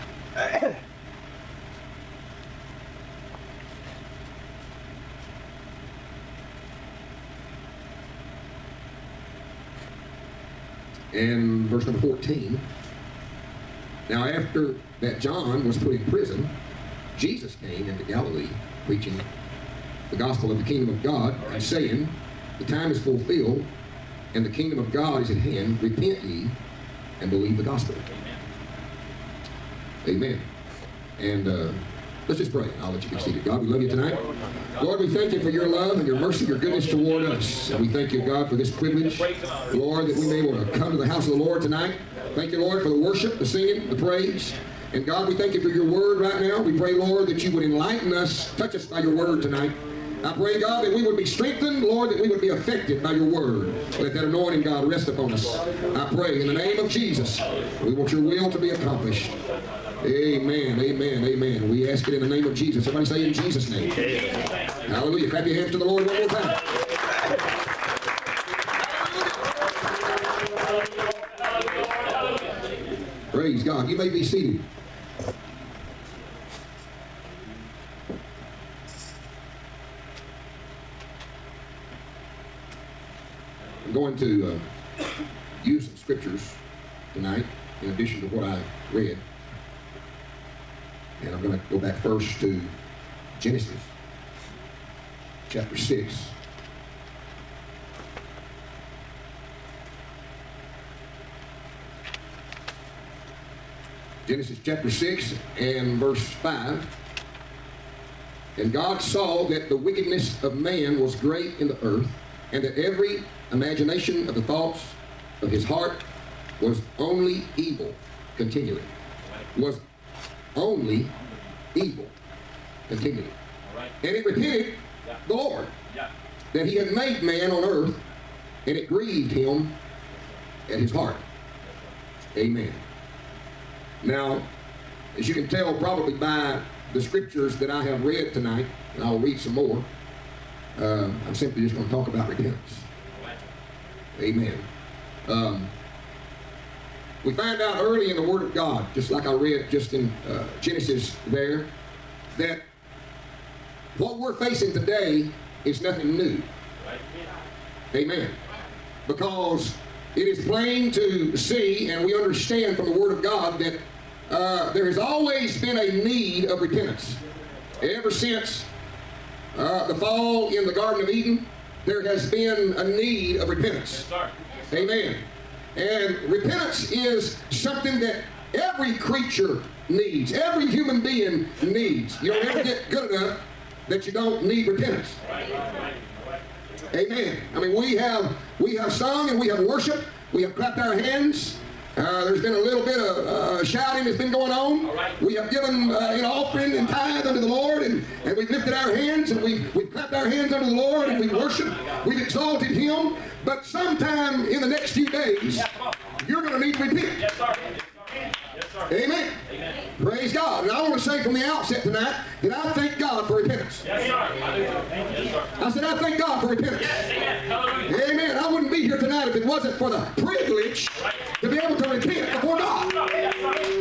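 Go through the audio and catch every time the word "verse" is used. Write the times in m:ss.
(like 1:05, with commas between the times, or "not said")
0:11, 1:45.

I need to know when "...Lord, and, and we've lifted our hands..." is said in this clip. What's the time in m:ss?
3:17.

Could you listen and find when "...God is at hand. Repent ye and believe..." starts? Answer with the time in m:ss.
0:24.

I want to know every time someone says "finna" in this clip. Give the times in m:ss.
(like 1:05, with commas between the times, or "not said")
not said.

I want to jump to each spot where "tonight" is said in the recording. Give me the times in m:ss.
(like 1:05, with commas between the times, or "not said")
0:33, 0:41, 0:49, 2:18, 3:31, 3:38.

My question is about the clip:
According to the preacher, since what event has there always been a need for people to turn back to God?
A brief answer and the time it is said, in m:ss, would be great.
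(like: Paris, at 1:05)
The fall in the Garden of Eden, at 2:49.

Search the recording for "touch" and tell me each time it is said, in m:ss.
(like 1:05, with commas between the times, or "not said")
0:48.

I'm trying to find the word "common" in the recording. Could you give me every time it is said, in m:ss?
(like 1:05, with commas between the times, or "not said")
not said.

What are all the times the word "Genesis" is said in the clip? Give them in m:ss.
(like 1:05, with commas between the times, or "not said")
1:33, 1:44, 2:30.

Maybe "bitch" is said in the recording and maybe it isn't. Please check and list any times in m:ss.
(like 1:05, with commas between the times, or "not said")
not said.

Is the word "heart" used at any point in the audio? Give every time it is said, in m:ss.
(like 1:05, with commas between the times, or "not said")
1:55, 2:10.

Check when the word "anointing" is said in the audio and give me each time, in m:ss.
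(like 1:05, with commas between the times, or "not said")
0:54.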